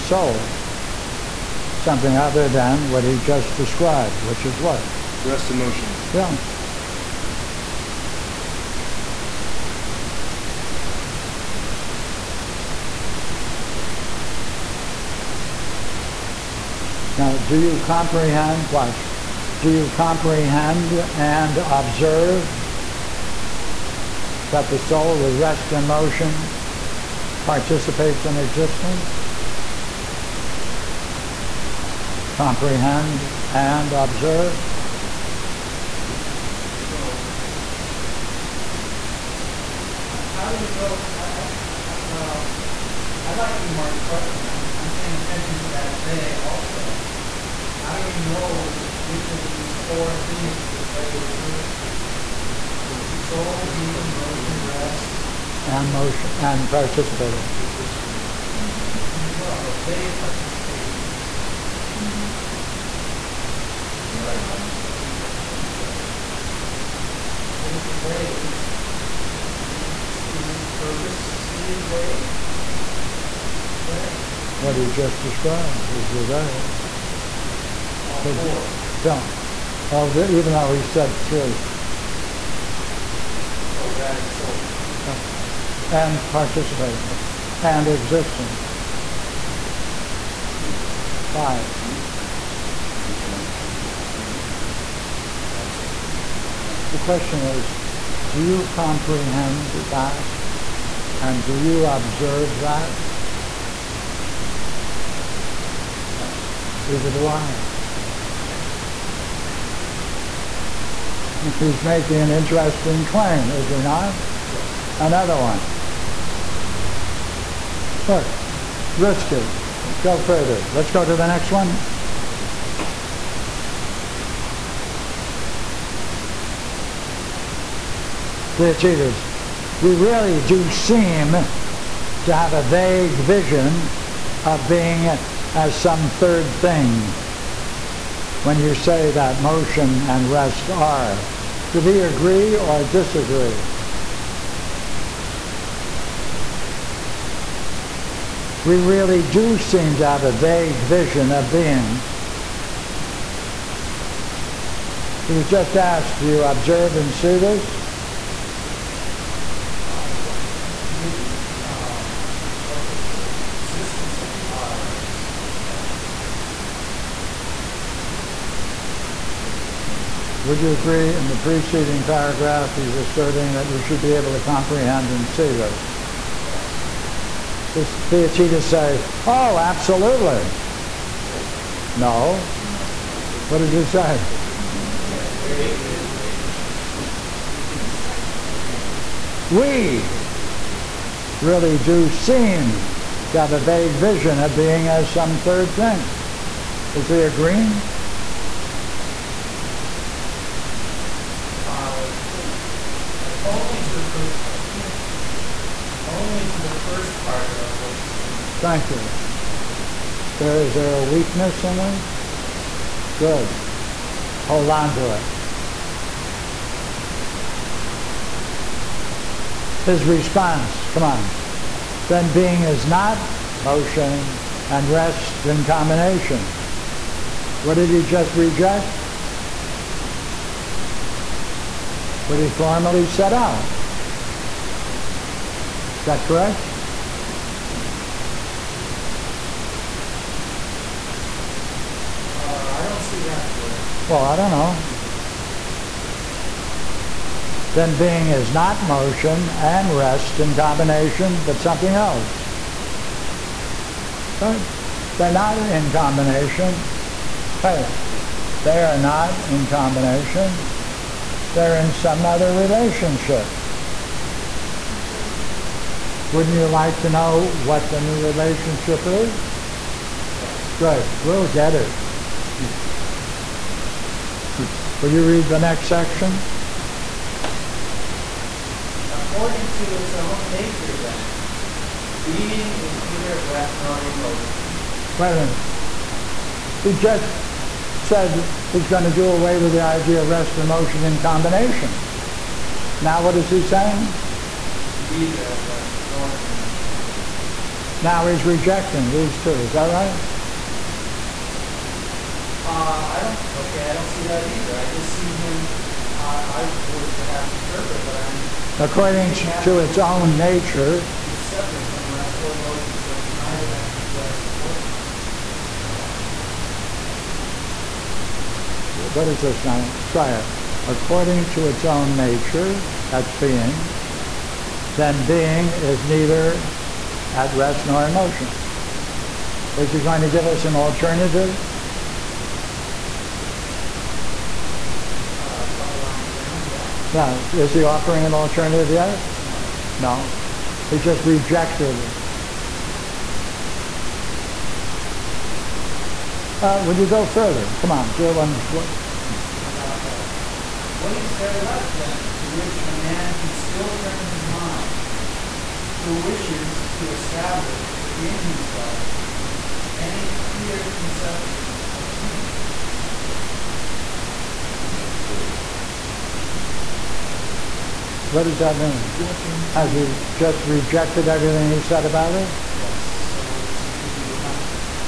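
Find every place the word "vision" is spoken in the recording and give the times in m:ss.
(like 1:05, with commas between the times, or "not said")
2:13, 2:30, 3:13.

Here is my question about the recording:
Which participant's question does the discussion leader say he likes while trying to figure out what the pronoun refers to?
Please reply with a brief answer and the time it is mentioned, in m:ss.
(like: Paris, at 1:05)
Ingmar, at 0:43.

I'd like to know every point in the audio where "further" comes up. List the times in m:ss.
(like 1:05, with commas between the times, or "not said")
2:00, 5:47.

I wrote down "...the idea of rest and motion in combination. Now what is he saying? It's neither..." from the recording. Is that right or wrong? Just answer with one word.
right.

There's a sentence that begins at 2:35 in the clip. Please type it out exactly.
He was just asked, do you observe and see this?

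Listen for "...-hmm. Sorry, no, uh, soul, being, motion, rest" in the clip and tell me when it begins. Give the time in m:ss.
1:02.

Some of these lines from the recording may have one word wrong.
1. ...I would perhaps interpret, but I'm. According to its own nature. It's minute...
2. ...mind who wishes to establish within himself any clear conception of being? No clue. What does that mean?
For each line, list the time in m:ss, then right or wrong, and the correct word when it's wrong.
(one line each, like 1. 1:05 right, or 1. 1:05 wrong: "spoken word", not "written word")
1. 5:06 wrong: "separate", not "minute"
2. 5:54 right.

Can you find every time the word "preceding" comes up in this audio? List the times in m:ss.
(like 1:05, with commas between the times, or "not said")
2:51.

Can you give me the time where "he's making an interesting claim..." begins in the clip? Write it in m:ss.
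1:51.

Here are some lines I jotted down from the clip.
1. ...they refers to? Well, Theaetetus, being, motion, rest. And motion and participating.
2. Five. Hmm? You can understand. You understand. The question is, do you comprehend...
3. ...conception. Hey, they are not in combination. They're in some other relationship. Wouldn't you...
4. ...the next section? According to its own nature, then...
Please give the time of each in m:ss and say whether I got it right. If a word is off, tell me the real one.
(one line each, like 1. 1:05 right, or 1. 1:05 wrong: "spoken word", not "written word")
1. 0:50 wrong: "Soul", not "Theaetetus"
2. 1:31 right
3. 4:15 wrong: "combination", not "conception"
4. 4:35 right.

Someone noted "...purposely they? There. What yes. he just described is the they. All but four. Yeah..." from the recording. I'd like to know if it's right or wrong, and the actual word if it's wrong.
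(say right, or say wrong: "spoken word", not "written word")
right.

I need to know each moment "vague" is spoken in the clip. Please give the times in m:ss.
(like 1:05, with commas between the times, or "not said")
2:12, 2:30, 3:13.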